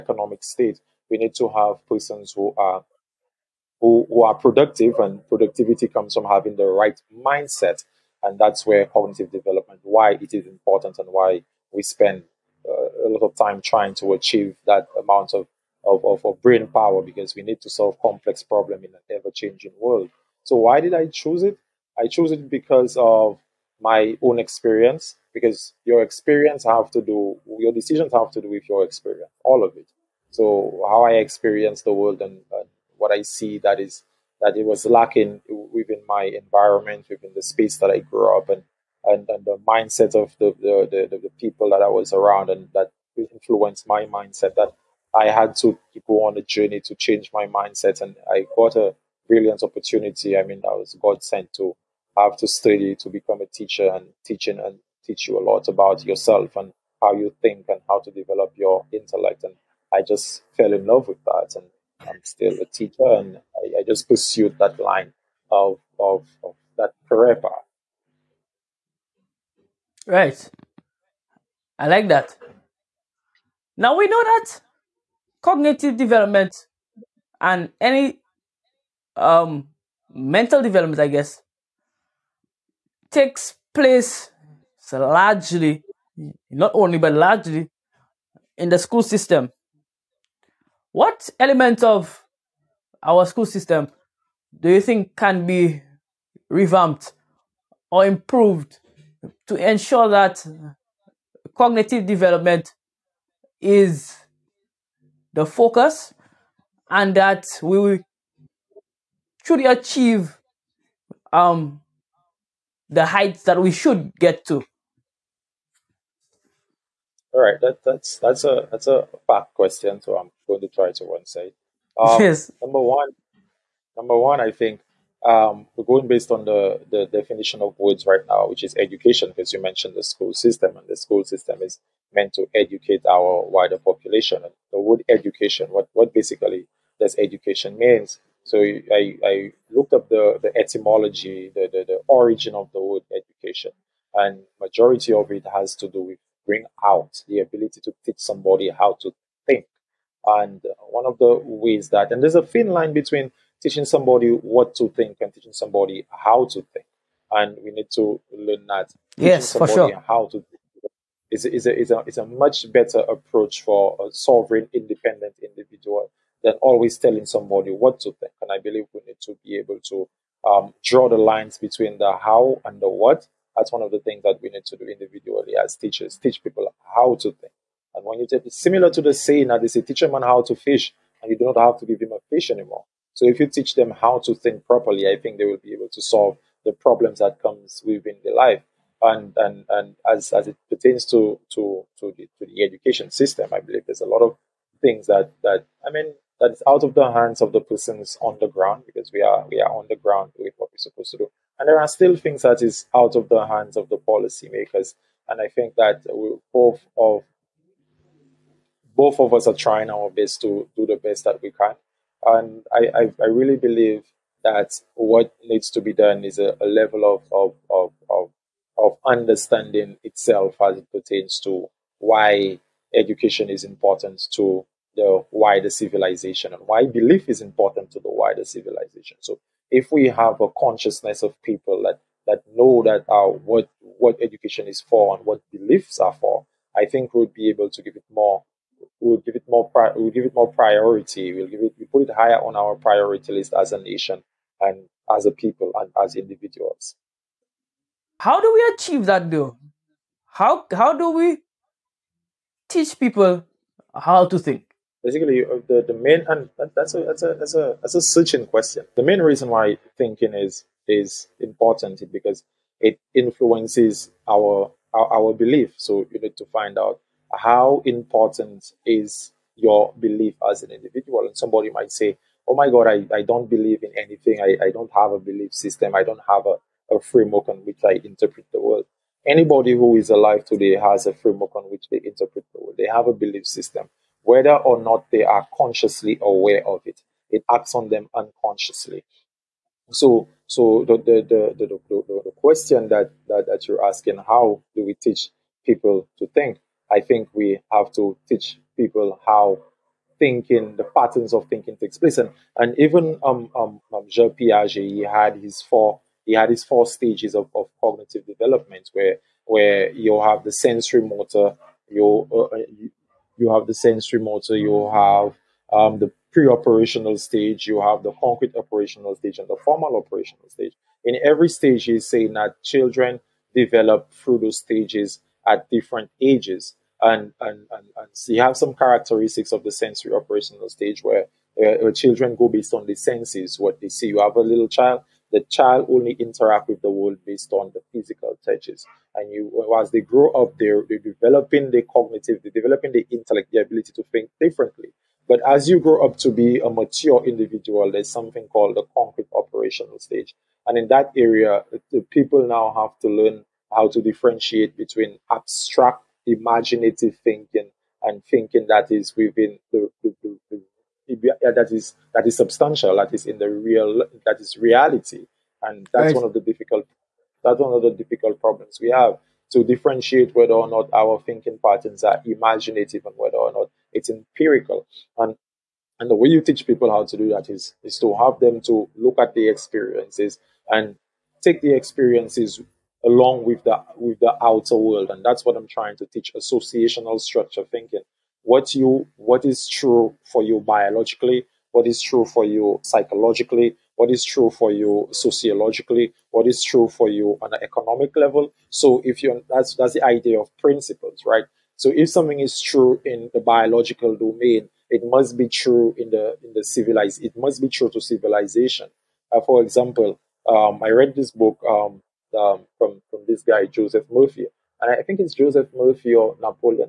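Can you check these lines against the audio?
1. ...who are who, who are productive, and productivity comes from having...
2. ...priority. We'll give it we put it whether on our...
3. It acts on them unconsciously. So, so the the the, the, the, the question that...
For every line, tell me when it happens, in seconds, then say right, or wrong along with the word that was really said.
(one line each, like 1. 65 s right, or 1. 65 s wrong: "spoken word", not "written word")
1. 2 s right
2. 240 s wrong: "higher", not "whether"
3. 287 s right.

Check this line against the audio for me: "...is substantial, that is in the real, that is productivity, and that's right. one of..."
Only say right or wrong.
wrong.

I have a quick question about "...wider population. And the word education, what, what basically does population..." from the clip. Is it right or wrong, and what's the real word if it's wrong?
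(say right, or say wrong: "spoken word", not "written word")
wrong: "education", not "population".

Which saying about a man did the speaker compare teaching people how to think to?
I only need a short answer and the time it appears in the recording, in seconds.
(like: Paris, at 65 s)
teach a man how to fish, at 179 s.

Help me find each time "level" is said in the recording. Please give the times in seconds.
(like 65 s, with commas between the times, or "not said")
216 s, 398 s.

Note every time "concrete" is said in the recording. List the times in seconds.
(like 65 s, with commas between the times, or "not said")
318 s, 348 s.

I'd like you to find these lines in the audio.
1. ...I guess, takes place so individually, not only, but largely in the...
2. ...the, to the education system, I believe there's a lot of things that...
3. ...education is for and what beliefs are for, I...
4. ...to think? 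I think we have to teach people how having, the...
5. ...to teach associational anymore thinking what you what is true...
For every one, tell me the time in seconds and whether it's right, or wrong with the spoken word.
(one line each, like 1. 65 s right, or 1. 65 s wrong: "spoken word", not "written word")
1. 80 s wrong: "largely", not "individually"
2. 192 s right
3. 234 s right
4. 296 s wrong: "thinking", not "having"
5. 385 s wrong: "structure", not "anymore".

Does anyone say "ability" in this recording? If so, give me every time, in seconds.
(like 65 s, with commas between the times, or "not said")
147 s, 343 s.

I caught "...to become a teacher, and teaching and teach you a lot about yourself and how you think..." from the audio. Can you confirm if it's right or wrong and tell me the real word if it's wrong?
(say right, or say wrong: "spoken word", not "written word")
right.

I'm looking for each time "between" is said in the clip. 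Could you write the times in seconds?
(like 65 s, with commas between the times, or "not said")
152 s, 171 s, 354 s.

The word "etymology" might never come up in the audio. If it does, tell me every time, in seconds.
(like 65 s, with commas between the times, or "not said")
140 s.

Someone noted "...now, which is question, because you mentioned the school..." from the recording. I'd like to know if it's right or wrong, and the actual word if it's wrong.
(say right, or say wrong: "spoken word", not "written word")
wrong: "education", not "question".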